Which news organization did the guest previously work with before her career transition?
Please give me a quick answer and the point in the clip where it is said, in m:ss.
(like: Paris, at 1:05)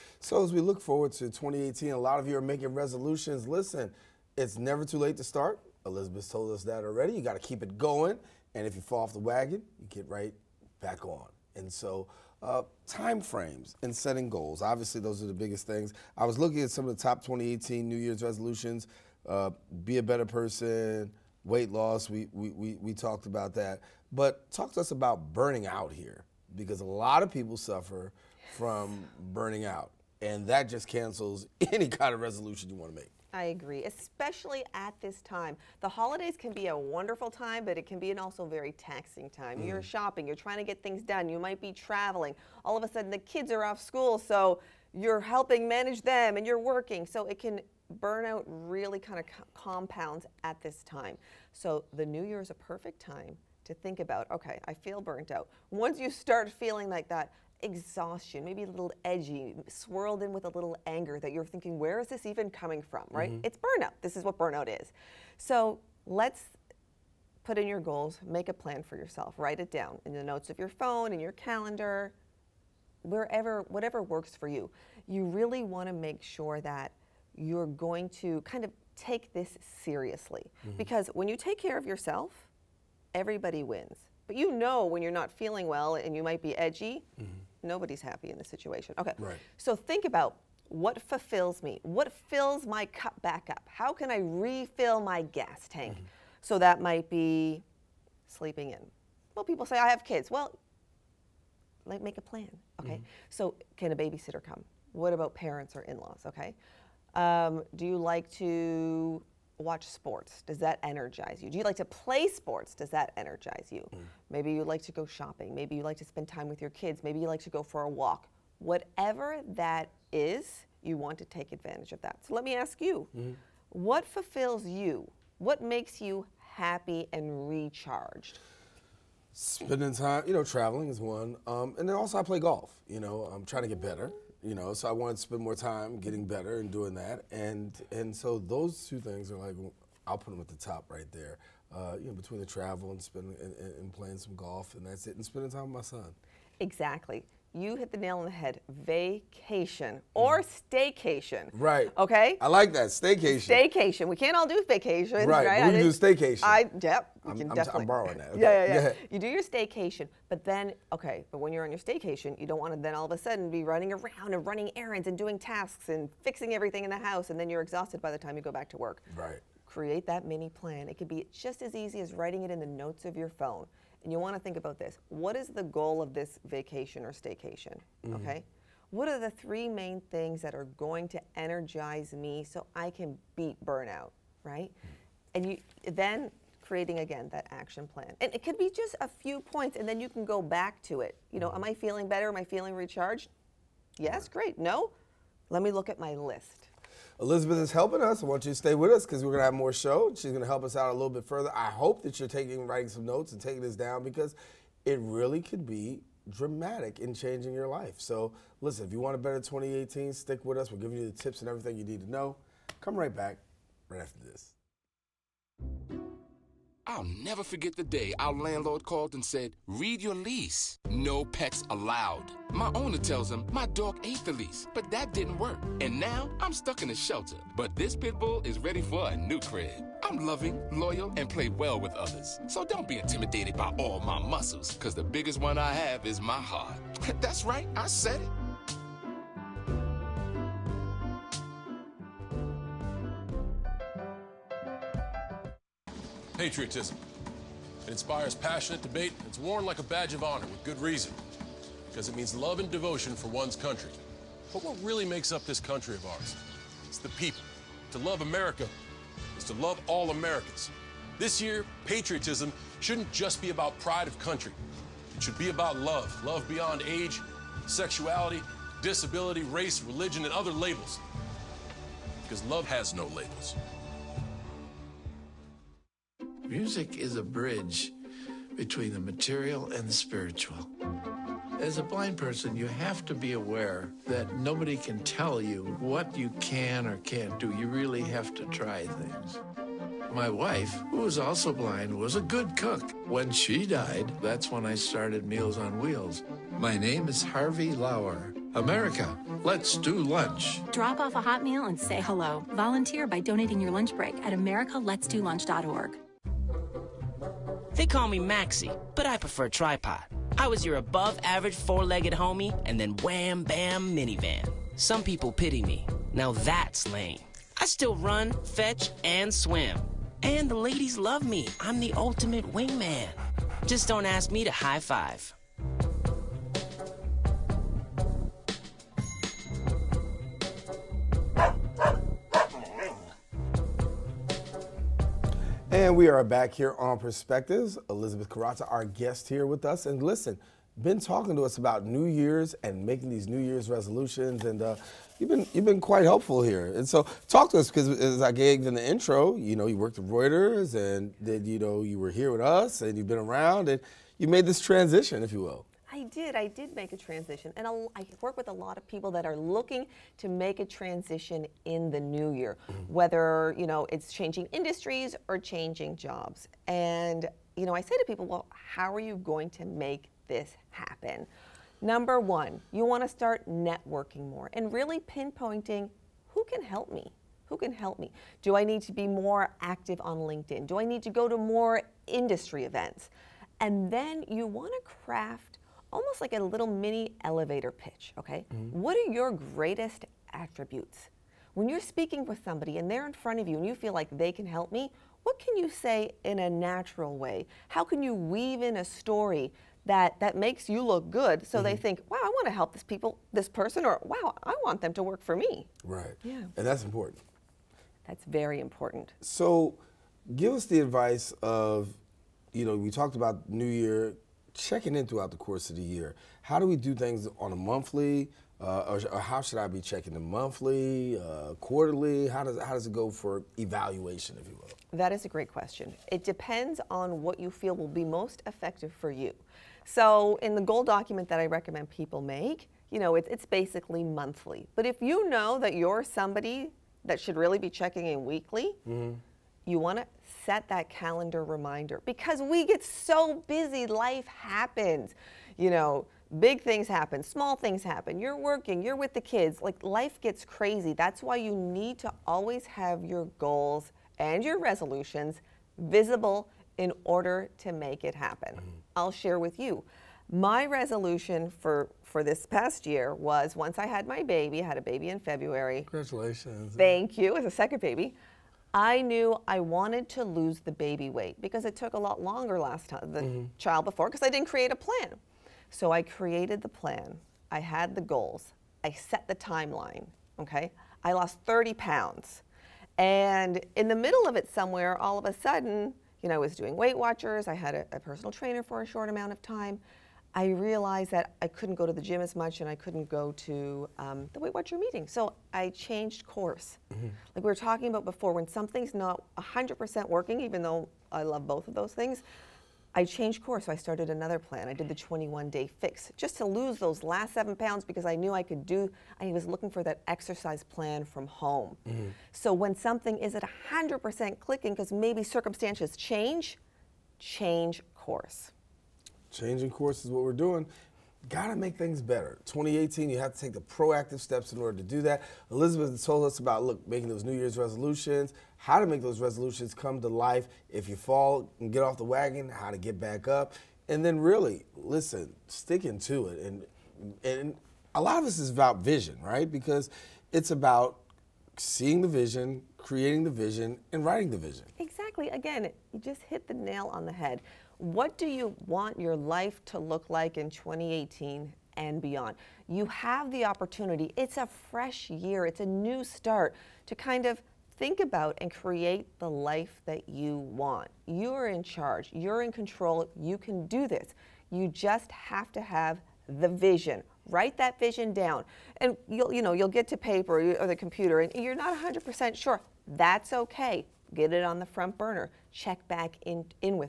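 Reuters, at 5:50.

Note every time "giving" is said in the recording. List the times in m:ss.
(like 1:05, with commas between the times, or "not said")
3:30.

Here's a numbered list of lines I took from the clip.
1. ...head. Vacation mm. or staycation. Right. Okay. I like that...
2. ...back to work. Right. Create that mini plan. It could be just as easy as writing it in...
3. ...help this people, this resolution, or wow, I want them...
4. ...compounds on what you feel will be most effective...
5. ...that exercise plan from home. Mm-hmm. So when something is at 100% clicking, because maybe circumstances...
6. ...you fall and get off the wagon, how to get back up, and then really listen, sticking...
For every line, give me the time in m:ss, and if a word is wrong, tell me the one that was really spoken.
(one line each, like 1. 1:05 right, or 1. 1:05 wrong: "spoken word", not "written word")
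1. 2:28 right
2. 2:48 right
3. 6:42 wrong: "person", not "resolution"
4. 7:06 wrong: "depends", not "compounds"
5. 8:29 right
6. 8:50 right.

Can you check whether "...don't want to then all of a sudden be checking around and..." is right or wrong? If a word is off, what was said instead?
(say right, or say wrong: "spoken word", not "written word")
wrong: "running", not "checking".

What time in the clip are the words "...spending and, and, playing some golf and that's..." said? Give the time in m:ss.
2:23.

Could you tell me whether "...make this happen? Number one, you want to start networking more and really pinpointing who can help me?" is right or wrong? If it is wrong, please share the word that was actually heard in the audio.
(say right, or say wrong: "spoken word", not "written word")
right.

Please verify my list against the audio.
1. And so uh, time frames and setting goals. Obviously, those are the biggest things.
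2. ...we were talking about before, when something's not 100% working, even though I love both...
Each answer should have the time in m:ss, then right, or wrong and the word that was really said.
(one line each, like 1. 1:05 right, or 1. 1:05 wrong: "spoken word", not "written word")
1. 0:11 right
2. 8:17 right.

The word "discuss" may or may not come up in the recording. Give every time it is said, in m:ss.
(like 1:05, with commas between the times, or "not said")
not said.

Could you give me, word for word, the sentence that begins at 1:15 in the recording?
You really want to make sure that you're going to kind of take this seriously.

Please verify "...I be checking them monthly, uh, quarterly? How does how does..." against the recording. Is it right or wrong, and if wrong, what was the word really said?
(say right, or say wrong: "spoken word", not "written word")
right.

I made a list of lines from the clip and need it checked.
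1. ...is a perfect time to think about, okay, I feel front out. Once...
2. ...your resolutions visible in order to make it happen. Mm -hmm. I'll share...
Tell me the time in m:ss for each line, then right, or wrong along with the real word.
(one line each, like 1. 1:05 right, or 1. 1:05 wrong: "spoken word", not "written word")
1. 0:52 wrong: "burnt", not "front"
2. 7:34 right.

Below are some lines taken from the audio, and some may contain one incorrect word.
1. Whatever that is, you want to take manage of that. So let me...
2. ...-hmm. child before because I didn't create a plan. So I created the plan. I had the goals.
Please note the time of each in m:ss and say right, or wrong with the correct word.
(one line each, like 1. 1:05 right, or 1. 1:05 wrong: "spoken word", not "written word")
1. 1:58 wrong: "advantage", not "manage"
2. 7:53 right.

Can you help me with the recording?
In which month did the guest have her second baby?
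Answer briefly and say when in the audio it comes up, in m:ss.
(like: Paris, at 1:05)
February, at 7:45.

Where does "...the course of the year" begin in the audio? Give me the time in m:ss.
6:55.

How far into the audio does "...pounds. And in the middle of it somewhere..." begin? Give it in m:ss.
8:01.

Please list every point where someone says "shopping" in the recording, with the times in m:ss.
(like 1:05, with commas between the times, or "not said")
0:39, 1:55.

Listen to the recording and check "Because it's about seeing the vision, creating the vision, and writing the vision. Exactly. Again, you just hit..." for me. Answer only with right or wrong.
right.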